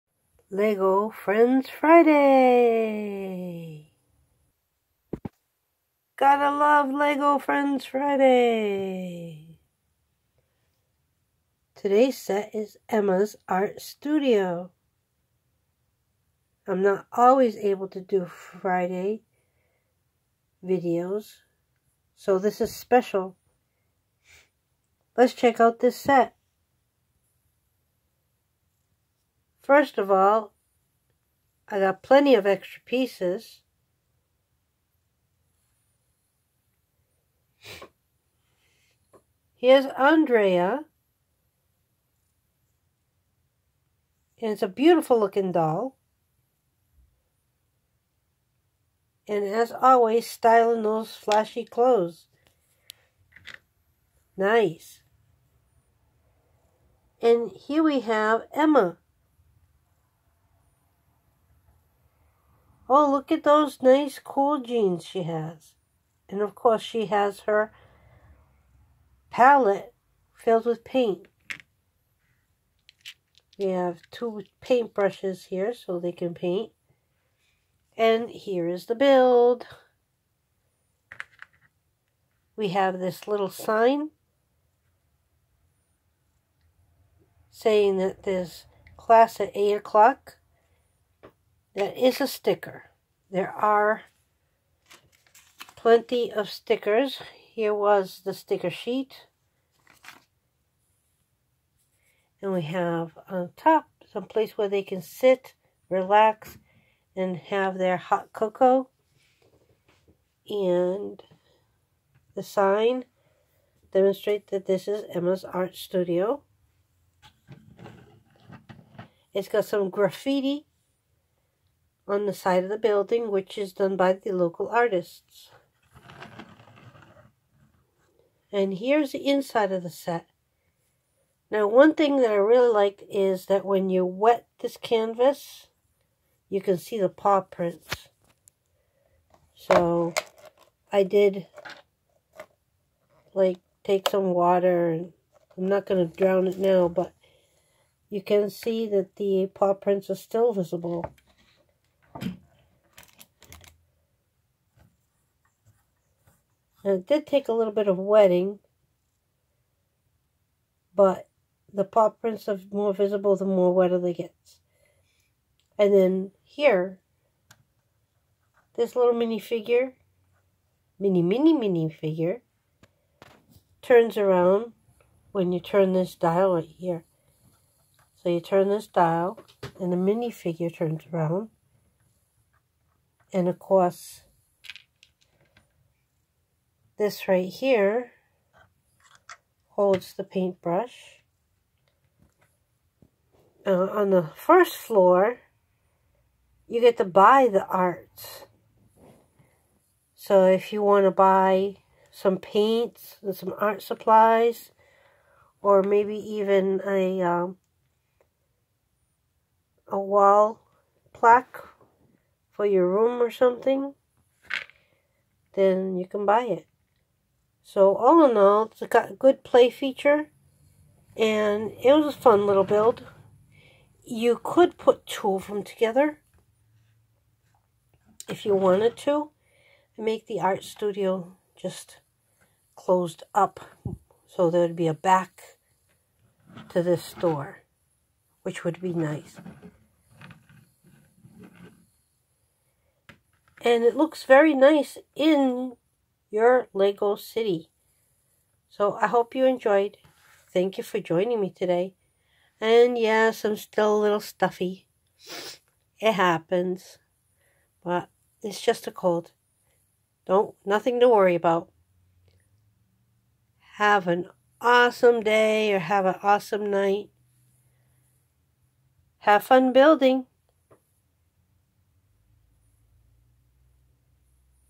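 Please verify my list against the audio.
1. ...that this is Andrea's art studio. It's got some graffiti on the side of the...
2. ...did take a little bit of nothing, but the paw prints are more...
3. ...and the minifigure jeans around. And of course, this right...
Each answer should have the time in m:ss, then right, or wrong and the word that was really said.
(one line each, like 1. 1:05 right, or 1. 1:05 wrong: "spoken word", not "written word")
1. 1:54 wrong: "Emma", not "Andrea"
2. 2:37 wrong: "wetting", not "nothing"
3. 2:59 wrong: "turns", not "jeans".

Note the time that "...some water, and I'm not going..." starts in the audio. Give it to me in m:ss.
2:24.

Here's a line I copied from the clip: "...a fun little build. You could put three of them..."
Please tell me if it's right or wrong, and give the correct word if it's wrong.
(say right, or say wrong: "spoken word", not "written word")
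wrong: "two", not "three".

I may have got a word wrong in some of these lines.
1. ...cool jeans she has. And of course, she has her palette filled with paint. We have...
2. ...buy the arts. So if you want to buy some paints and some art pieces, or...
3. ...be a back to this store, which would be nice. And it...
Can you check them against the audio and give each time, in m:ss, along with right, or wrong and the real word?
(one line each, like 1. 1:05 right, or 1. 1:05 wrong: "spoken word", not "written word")
1. 1:04 right
2. 3:17 wrong: "supplies", not "pieces"
3. 3:54 right.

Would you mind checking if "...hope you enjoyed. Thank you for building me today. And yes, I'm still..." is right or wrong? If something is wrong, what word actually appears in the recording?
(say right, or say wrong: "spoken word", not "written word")
wrong: "joining", not "building".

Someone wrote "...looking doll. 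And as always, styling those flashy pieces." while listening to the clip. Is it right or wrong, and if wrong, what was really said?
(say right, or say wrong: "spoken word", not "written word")
wrong: "clothes", not "pieces".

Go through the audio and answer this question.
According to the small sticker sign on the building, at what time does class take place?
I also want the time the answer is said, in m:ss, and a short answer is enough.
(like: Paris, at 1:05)
8 o'clock, at 1:29.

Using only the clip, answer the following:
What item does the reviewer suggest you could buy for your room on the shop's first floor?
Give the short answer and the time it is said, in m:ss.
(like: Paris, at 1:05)
A wall plaque, at 3:29.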